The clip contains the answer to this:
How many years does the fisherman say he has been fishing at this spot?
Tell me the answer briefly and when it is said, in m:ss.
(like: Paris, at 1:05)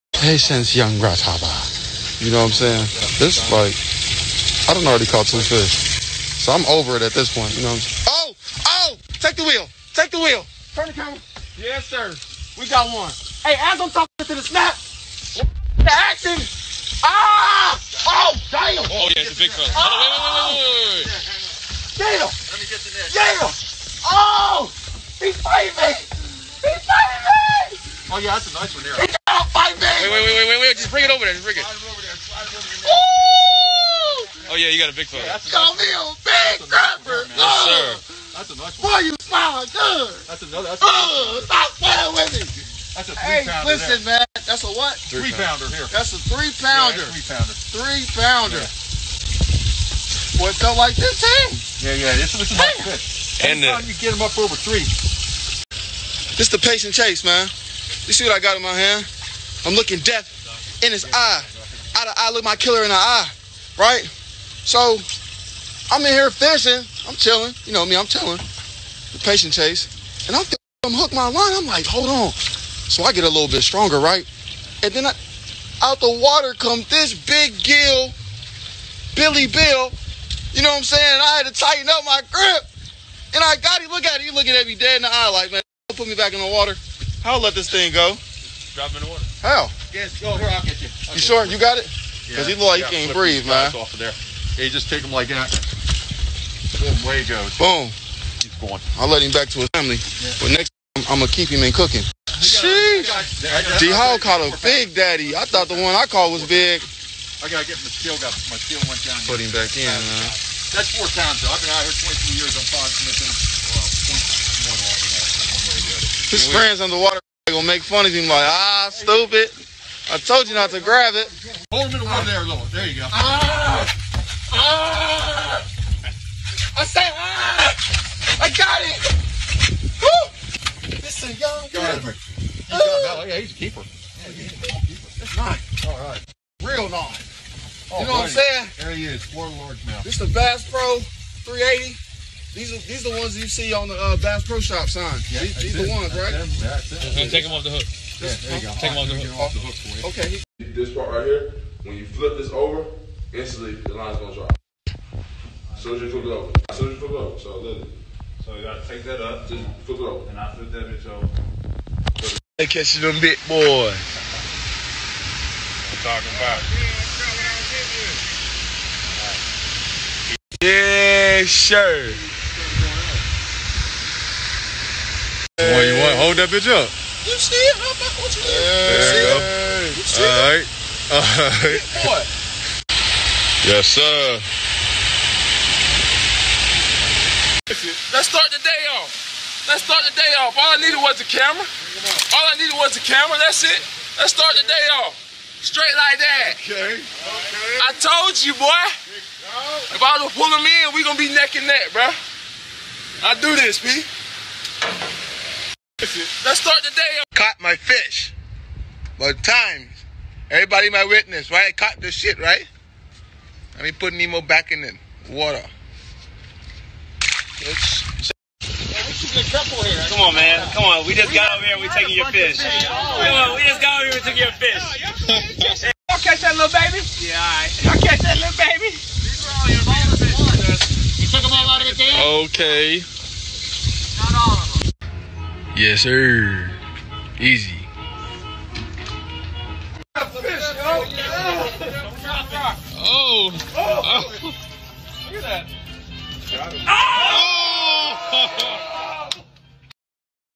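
22, at 1:52.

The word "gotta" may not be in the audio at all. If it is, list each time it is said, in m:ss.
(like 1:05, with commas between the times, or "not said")
1:47, 2:38.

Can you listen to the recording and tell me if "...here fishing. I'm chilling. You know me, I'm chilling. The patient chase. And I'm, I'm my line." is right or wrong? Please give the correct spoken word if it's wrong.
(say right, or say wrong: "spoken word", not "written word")
right.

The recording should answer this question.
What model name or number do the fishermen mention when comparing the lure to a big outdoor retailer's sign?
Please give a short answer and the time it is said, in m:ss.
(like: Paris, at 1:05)
Bass Pro 380, at 2:20.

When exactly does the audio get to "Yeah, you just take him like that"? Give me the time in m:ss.
1:34.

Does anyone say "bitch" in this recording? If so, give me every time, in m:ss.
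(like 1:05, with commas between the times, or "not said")
2:40, 2:56.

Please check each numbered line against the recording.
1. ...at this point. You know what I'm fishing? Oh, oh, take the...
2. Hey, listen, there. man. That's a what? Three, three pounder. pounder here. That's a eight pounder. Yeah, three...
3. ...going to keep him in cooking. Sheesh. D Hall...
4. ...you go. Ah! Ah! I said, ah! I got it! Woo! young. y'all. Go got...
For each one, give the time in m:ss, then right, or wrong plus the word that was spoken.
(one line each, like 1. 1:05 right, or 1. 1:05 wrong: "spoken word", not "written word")
1. 0:07 wrong: "saying", not "fishing"
2. 0:43 wrong: "three", not "eight"
3. 1:41 right
4. 2:02 right.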